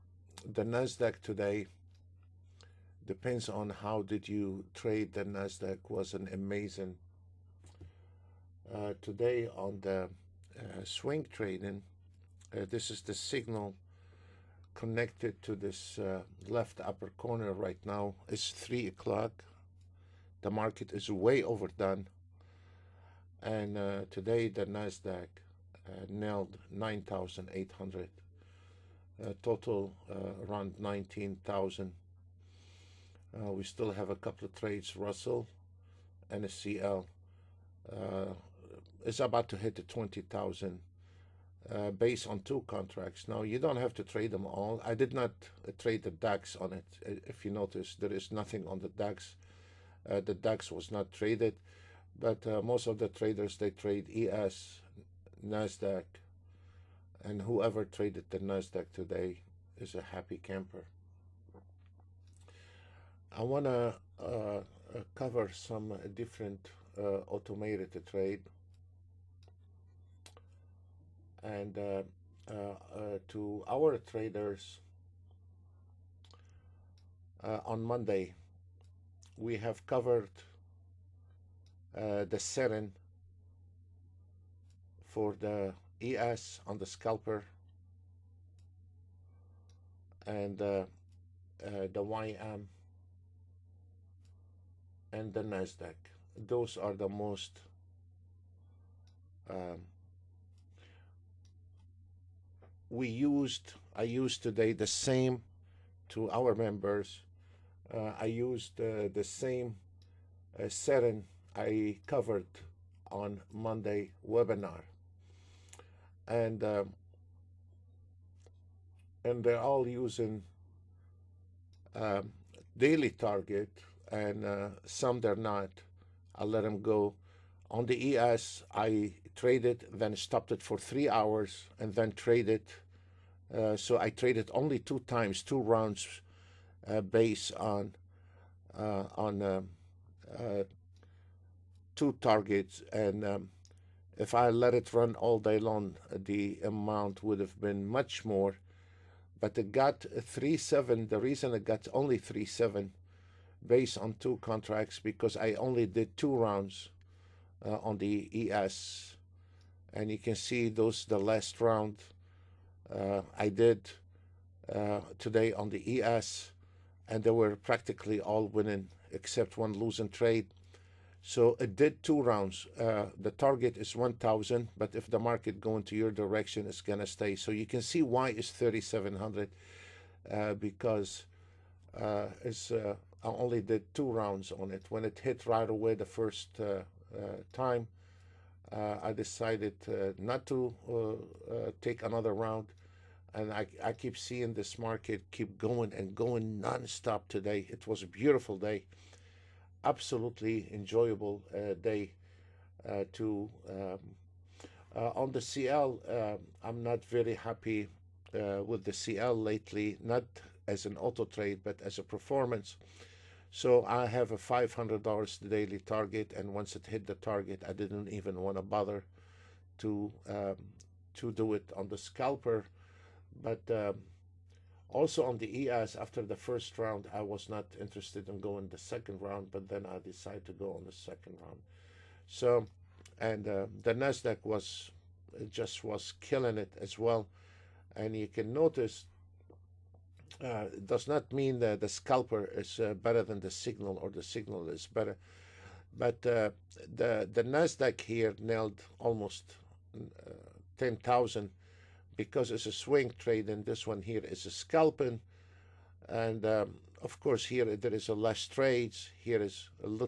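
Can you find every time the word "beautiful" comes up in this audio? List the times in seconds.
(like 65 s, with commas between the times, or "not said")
198 s.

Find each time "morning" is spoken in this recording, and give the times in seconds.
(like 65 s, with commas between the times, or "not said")
not said.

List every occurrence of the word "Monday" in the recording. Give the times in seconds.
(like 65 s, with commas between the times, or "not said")
77 s, 113 s.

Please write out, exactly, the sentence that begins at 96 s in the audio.
Those are the most um, we used, I used today the same to our members.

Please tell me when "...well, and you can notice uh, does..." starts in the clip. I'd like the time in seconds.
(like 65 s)
236 s.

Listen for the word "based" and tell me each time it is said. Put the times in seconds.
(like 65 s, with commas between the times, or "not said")
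41 s, 137 s, 153 s.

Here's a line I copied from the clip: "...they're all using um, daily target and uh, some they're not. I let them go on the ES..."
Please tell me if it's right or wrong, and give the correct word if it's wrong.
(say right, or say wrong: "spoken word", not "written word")
right.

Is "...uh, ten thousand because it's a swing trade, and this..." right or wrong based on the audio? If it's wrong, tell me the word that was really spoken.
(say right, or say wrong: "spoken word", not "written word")
right.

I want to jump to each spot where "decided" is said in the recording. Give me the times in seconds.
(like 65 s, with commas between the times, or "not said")
189 s, 229 s.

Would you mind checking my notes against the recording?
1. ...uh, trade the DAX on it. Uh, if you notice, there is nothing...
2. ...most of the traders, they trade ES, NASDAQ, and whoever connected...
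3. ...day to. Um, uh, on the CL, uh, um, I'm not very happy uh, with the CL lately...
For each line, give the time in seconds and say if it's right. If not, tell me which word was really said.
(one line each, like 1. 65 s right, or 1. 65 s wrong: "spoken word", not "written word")
1. 45 s right
2. 52 s wrong: "traded", not "connected"
3. 201 s right.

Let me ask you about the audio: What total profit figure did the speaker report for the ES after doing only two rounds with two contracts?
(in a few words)
3,700.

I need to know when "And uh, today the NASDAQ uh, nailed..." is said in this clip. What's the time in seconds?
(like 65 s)
23 s.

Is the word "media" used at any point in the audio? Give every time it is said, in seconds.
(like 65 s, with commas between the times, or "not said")
not said.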